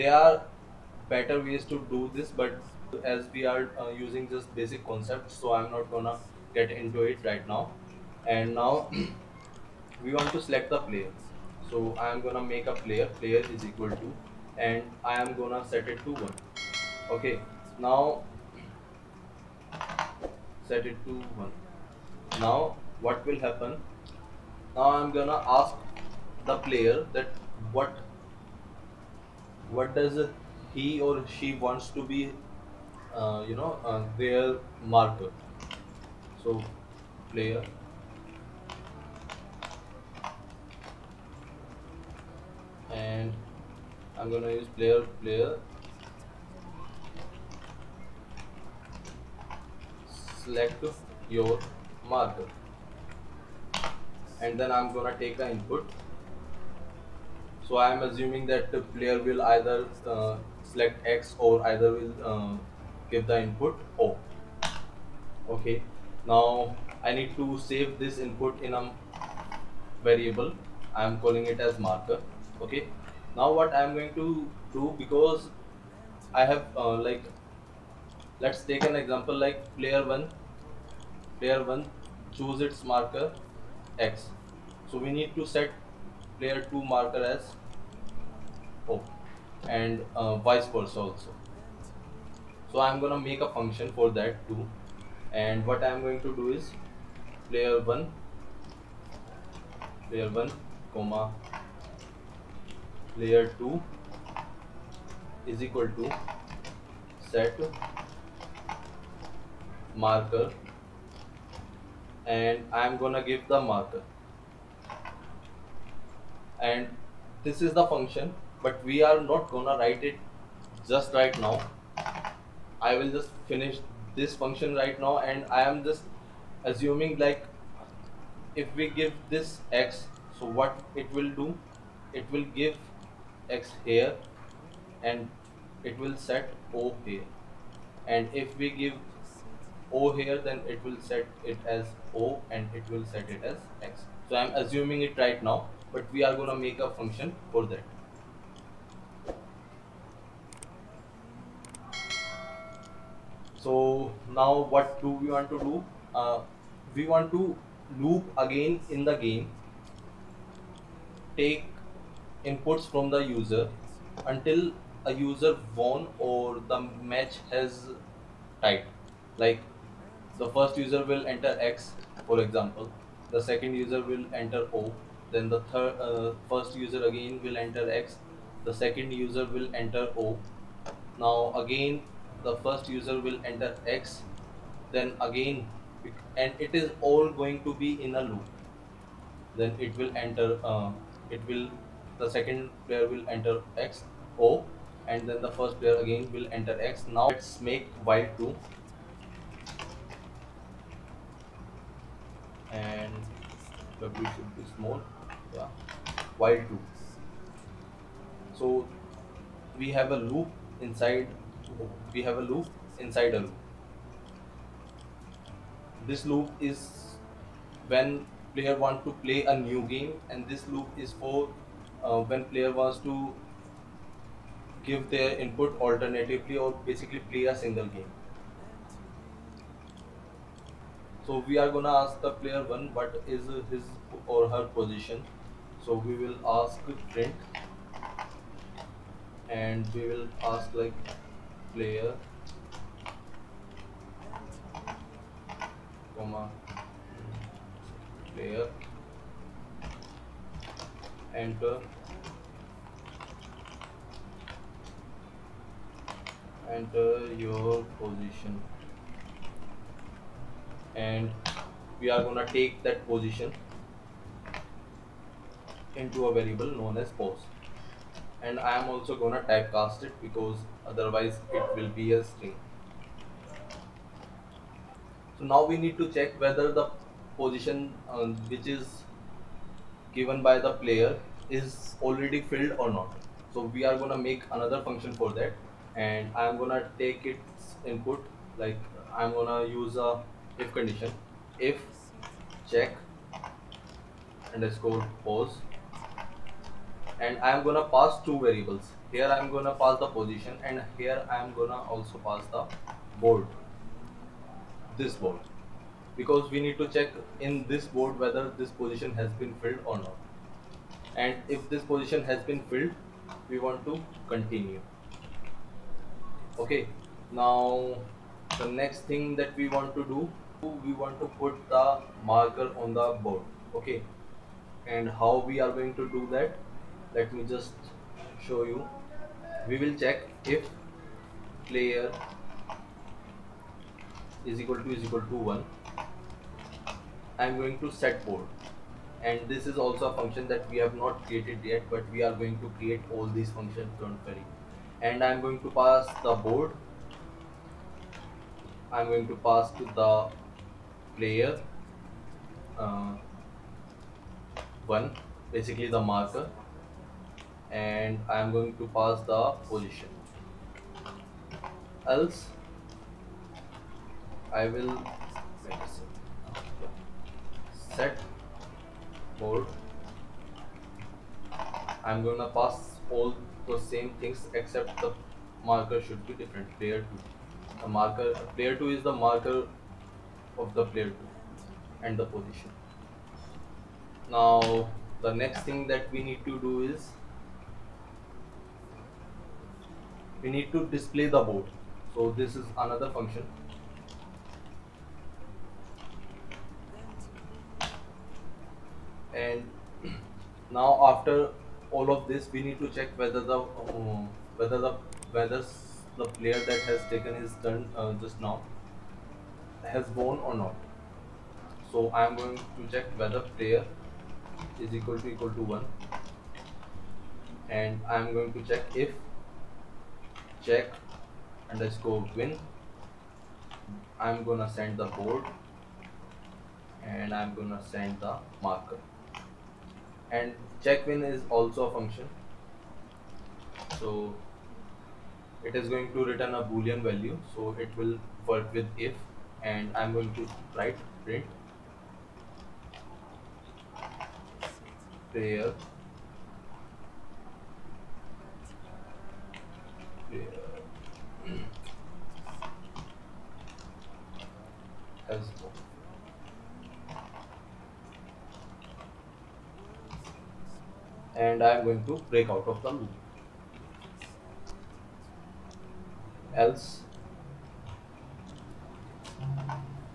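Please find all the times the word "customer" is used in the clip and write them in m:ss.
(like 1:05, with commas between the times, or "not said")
not said.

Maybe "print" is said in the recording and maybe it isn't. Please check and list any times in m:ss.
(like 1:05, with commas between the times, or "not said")
3:57, 7:21.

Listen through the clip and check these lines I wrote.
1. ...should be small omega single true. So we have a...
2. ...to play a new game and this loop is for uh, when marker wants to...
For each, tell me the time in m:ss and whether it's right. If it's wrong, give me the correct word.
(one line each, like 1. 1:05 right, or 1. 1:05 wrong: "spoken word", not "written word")
1. 3:24 wrong: "while", not "single"
2. 3:39 wrong: "player", not "marker".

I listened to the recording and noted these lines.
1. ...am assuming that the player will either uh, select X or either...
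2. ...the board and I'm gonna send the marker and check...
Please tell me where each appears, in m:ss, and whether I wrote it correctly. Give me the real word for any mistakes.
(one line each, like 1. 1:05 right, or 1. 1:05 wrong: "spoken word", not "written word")
1. 0:57 right
2. 7:04 right.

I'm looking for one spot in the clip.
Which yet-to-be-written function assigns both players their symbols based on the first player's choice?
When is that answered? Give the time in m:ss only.
1:47.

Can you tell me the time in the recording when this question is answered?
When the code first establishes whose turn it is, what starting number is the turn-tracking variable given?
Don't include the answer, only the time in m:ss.
0:15.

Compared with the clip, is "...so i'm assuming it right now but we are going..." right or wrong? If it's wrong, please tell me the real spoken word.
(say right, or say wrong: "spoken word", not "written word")
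right.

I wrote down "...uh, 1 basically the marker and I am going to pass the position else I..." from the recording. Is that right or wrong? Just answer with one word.
right.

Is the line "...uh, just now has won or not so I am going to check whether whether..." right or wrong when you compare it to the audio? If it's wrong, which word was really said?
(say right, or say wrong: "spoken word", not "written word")
wrong: "player", not "whether".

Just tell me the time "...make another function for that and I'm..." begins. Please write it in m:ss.
4:44.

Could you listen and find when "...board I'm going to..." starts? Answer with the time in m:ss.
5:46.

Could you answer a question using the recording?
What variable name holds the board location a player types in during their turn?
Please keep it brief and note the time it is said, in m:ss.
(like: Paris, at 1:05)
post, at 4:27.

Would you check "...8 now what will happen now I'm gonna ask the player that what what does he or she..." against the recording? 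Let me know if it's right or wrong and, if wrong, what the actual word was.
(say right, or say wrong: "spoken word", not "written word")
wrong: "1", not "8".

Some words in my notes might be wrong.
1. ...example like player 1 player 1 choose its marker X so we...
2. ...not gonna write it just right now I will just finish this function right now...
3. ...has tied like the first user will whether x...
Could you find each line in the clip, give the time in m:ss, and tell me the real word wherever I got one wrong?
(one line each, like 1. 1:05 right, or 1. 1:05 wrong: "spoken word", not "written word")
1. 1:18 right
2. 1:59 right
3. 2:47 wrong: "enter", not "whether".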